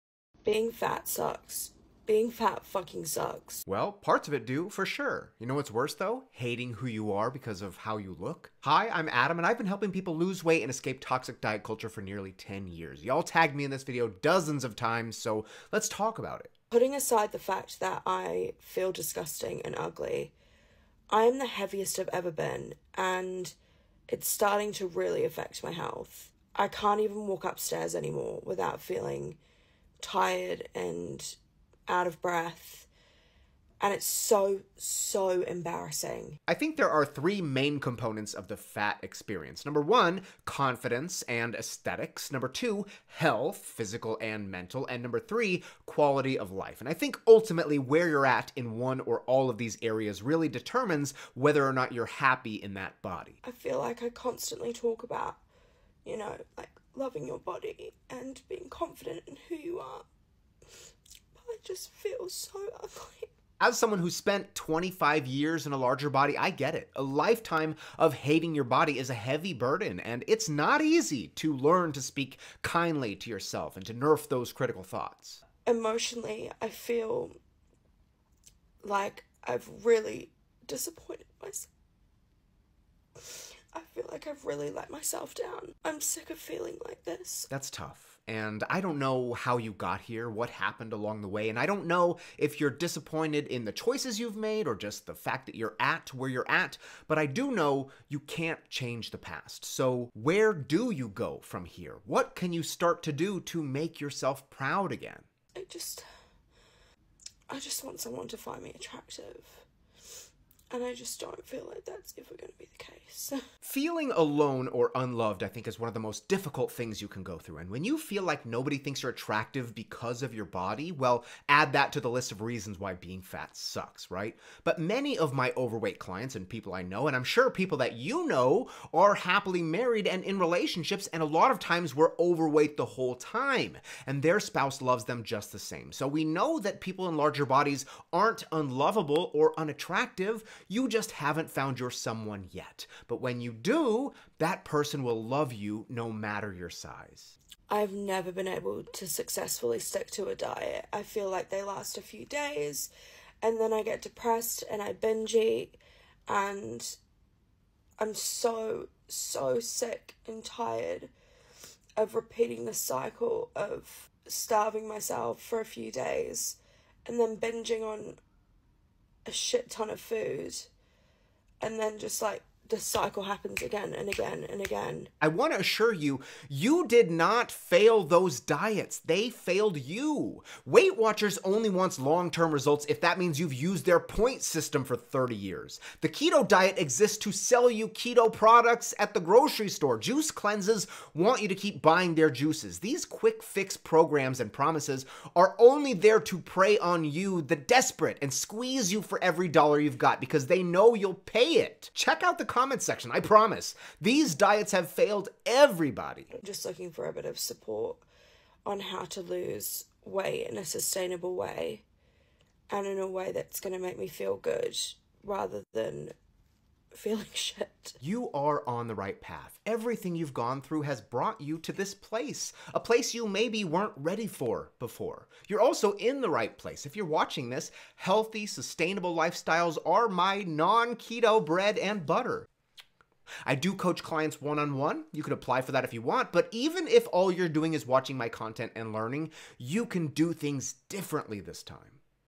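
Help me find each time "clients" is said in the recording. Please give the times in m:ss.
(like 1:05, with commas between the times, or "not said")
2:05, 3:54.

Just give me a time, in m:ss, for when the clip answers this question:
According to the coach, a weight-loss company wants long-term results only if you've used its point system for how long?
3:04.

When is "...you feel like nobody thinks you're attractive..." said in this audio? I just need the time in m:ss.
1:57.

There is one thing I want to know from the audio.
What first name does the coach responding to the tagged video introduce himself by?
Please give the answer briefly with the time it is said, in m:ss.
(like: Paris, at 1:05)
Adam, at 0:09.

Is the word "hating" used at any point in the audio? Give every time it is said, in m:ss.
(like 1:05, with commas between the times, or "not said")
0:06, 1:08.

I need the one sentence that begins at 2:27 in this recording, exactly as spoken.
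I've never been able to successfully stick to a diet.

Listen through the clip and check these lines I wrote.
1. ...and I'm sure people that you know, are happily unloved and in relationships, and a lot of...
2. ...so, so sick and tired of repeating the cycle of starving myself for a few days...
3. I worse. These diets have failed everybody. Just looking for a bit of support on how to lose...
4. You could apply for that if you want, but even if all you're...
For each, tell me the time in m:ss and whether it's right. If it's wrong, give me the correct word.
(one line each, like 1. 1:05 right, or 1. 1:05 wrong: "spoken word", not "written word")
1. 2:07 wrong: "married", not "unloved"
2. 2:38 right
3. 3:23 wrong: "promise", not "worse"
4. 3:55 right.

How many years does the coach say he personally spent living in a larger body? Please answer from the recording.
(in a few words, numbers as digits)
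25.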